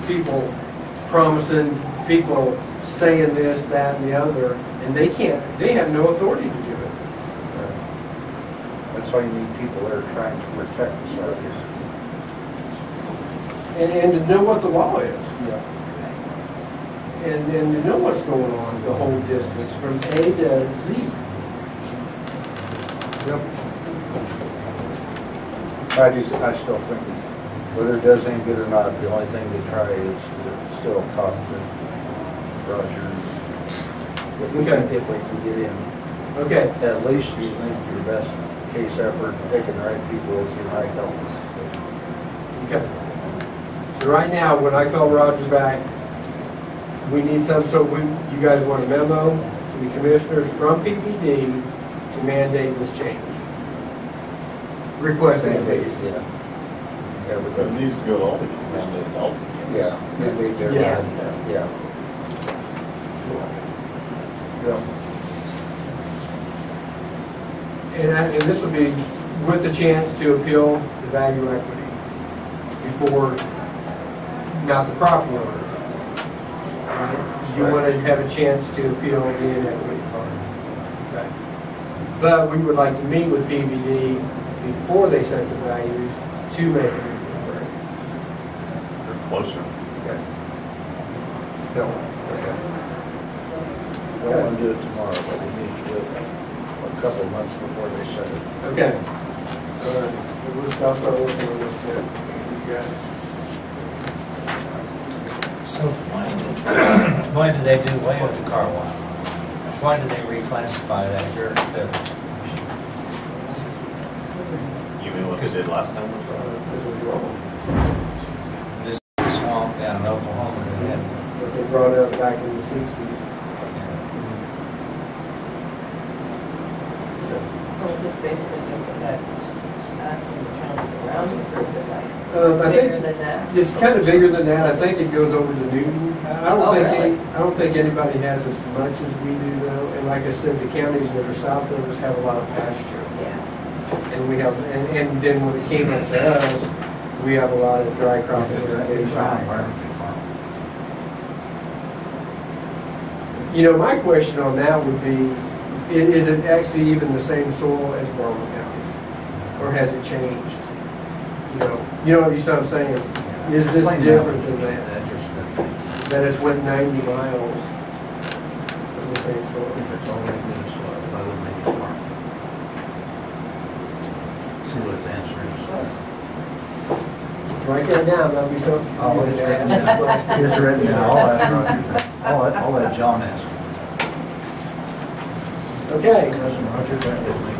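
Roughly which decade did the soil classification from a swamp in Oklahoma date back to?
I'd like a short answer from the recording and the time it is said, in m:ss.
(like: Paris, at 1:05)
the 60s, at 2:02.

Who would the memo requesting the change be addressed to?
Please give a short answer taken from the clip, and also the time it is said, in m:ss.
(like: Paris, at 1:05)
the commissioners, at 0:49.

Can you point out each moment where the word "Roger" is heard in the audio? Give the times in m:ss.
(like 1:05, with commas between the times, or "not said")
0:32, 0:45, 3:06.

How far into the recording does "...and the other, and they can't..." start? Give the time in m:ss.
0:03.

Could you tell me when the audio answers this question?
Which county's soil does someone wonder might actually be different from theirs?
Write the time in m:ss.
2:38.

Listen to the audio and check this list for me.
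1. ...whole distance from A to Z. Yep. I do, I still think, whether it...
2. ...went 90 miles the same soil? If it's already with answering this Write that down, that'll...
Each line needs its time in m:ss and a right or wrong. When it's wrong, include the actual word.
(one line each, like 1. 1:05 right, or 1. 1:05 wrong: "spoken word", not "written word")
1. 0:18 right
2. 2:46 right.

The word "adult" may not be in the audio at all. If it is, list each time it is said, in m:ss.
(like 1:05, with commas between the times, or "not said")
0:59.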